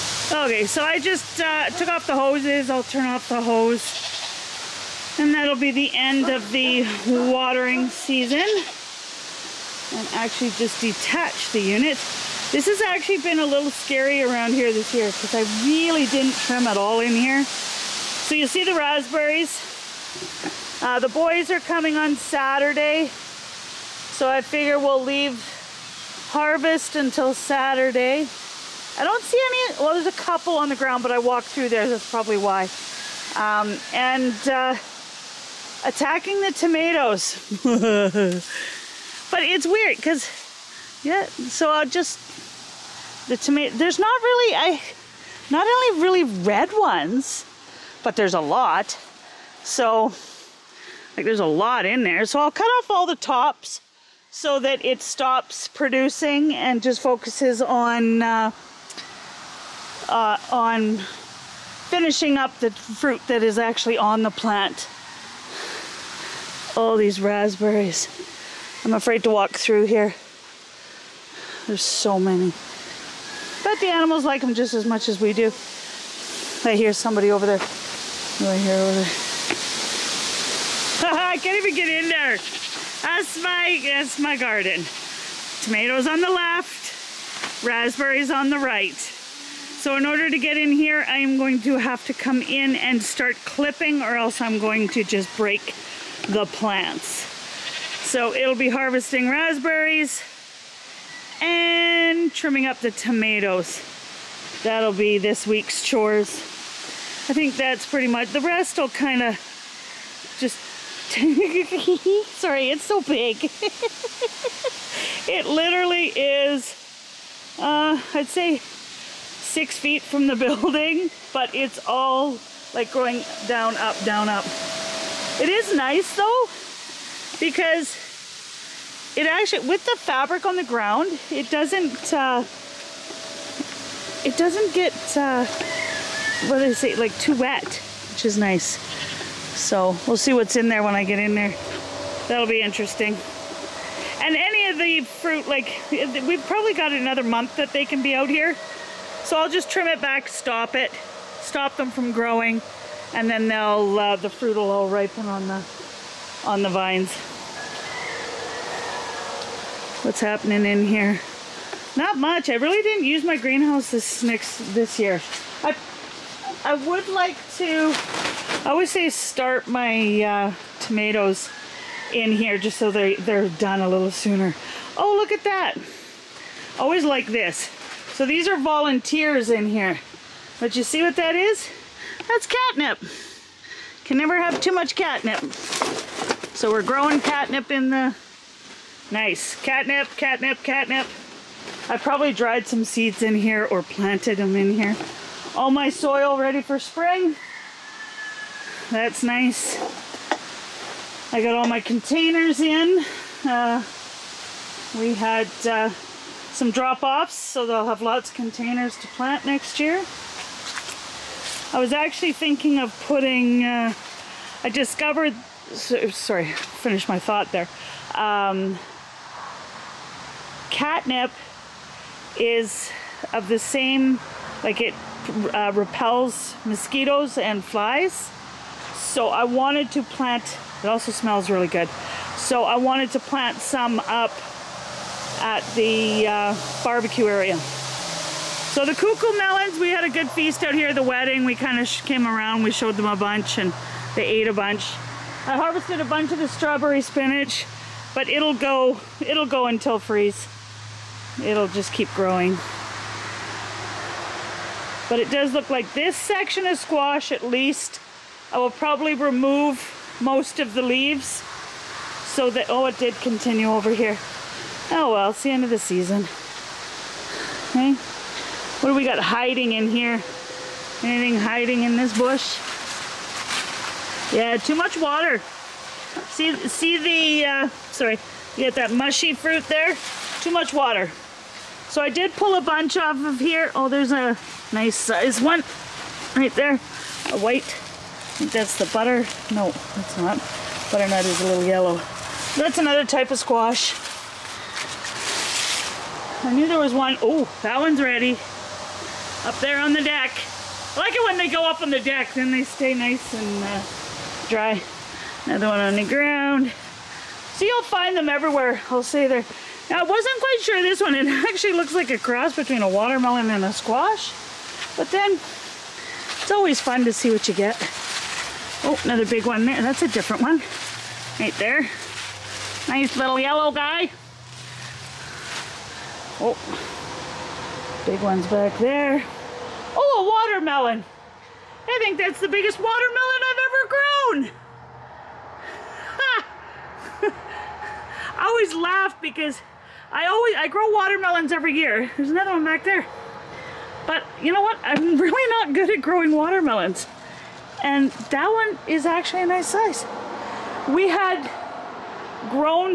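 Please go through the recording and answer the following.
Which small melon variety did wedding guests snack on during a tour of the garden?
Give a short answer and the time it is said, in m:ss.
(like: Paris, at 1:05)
Cuckoo melons, at 3:58.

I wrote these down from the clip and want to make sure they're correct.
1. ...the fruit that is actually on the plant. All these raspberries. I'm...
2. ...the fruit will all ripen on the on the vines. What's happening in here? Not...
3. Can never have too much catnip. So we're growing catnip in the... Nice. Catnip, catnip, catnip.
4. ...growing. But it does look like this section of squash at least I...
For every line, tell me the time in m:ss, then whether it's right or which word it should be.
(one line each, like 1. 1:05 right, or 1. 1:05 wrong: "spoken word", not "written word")
1. 1:02 right
2. 2:34 right
3. 3:04 right
4. 4:12 right.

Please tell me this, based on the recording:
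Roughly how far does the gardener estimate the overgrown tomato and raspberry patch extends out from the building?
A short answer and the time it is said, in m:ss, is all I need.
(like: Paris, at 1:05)
6 feet, at 1:58.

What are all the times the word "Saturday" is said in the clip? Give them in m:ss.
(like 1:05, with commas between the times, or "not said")
0:22, 0:27.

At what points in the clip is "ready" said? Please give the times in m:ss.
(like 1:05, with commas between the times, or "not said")
3:16, 4:58.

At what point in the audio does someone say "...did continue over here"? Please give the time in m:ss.
4:22.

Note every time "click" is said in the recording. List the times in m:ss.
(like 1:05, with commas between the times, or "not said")
not said.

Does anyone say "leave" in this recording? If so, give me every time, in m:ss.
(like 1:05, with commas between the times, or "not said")
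0:25, 4:20.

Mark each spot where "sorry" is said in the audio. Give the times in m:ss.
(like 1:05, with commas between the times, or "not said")
1:51, 3:35, 4:37.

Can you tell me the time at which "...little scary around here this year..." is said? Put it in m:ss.
0:13.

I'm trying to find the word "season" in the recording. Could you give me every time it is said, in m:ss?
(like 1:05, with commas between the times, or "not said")
0:07, 4:25.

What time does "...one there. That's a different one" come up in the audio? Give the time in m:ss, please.
5:19.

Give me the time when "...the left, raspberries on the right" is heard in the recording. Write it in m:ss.
1:26.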